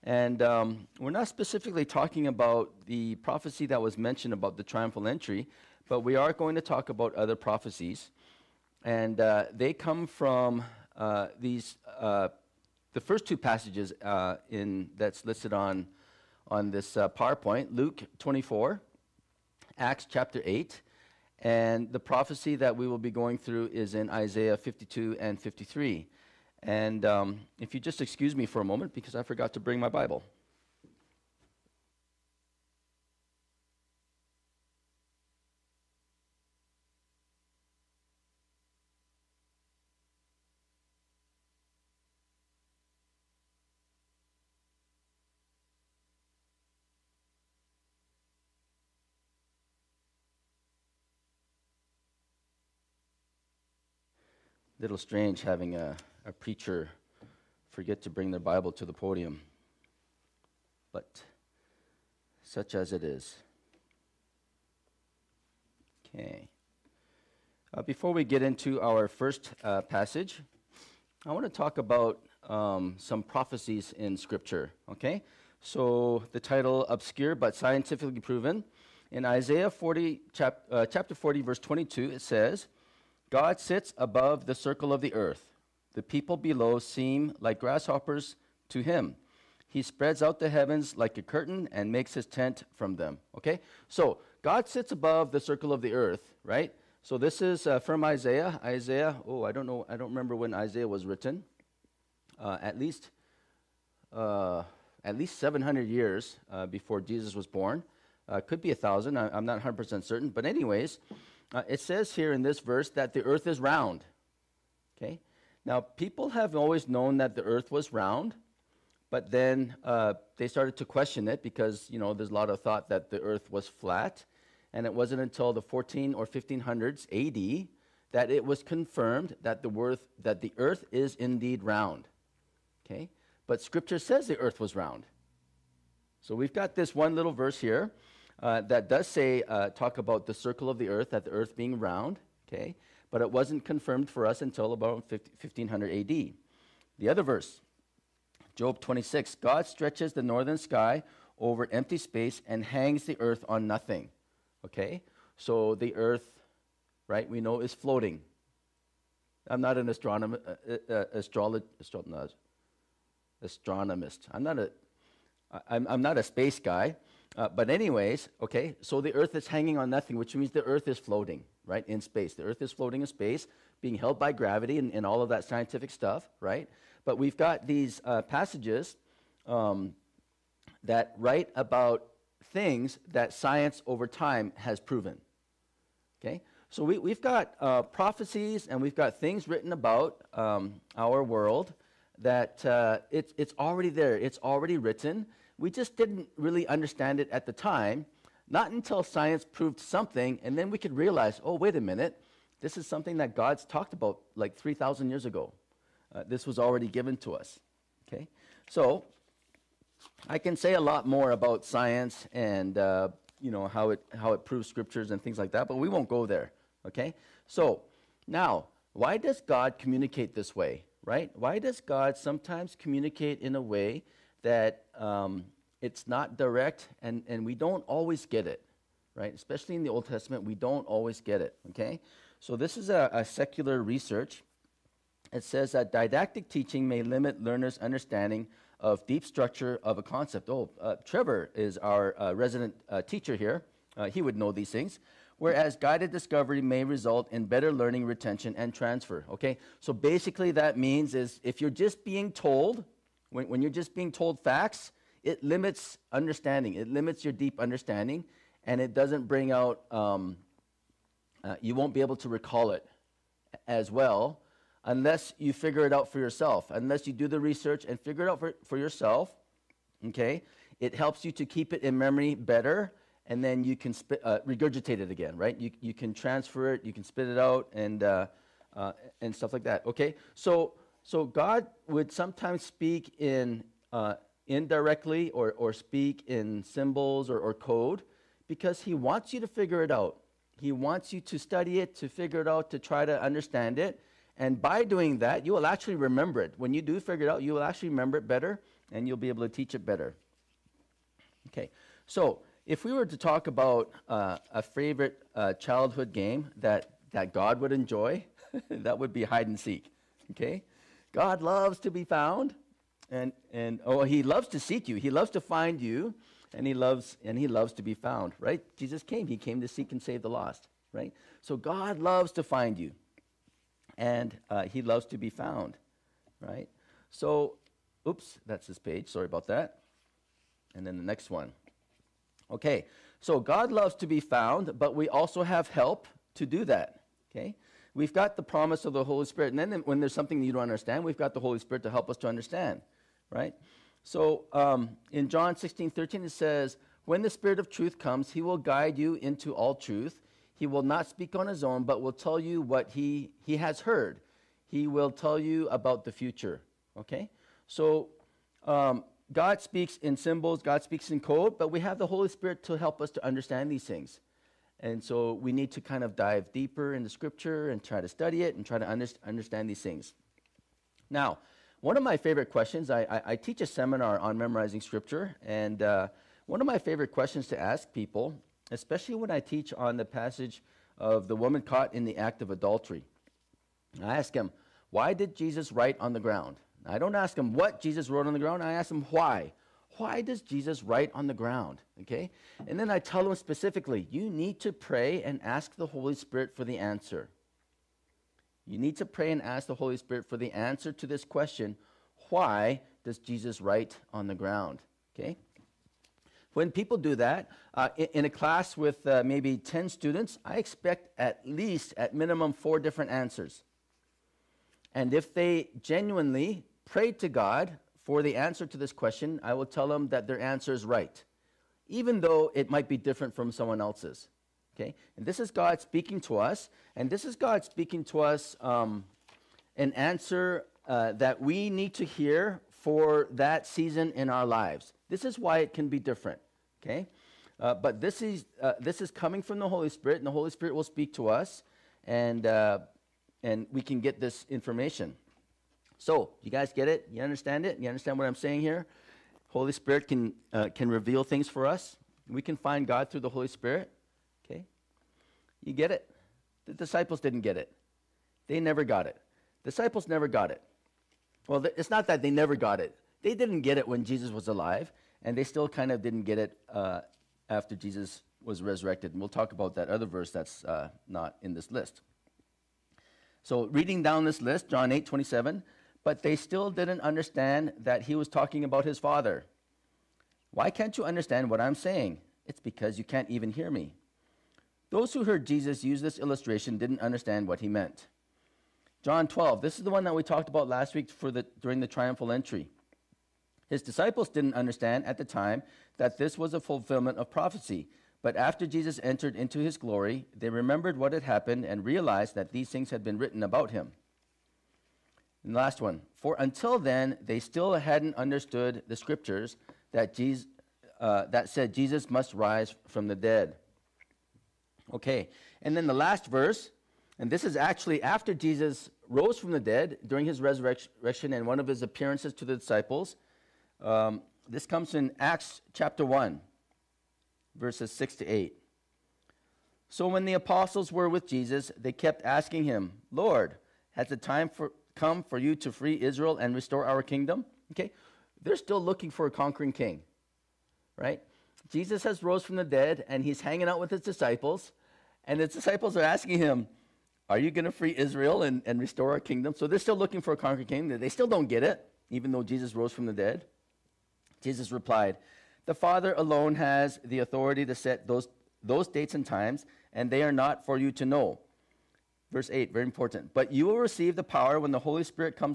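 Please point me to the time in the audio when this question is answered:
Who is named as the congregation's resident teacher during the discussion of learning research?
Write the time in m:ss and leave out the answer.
4:01.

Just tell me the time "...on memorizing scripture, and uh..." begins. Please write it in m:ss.
6:14.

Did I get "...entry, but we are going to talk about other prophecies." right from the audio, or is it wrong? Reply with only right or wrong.
right.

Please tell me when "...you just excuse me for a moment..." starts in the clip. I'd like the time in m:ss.
0:27.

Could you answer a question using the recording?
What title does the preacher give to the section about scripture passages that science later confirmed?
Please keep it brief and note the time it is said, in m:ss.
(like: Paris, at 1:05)
Obscure but Scientifically Proven, at 1:16.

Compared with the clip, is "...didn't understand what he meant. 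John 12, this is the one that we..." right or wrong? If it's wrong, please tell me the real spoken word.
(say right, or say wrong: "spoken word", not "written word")
right.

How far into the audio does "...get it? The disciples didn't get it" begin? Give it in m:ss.
7:35.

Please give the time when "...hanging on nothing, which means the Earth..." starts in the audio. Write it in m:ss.
2:49.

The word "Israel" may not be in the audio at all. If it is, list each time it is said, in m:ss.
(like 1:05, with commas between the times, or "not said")
8:56, 9:07.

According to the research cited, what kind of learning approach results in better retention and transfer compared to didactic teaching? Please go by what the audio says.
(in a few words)
Guided discovery.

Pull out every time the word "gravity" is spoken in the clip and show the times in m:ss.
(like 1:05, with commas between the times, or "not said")
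2:54.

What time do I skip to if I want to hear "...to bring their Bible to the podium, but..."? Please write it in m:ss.
0:58.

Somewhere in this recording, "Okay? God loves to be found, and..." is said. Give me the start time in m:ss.
5:10.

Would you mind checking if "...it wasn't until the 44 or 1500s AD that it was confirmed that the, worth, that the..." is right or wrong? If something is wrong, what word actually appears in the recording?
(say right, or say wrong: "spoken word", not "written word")
wrong: "14", not "44".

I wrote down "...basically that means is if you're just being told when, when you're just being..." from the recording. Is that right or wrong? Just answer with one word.
right.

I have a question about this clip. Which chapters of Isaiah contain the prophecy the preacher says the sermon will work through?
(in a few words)
Isaiah 52 and 53.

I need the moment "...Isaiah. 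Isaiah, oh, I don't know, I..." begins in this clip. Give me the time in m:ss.
1:38.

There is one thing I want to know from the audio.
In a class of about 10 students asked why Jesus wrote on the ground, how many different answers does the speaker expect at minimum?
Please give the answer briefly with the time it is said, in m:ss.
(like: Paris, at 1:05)
4, at 6:52.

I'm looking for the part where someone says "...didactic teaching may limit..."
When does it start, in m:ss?
3:55.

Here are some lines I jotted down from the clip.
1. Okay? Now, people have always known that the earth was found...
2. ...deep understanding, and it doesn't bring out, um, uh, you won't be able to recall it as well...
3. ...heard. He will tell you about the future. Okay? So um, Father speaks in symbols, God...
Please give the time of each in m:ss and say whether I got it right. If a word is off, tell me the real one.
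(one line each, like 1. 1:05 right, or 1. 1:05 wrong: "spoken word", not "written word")
1. 1:54 wrong: "round", not "found"
2. 4:17 right
3. 5:53 wrong: "God", not "Father".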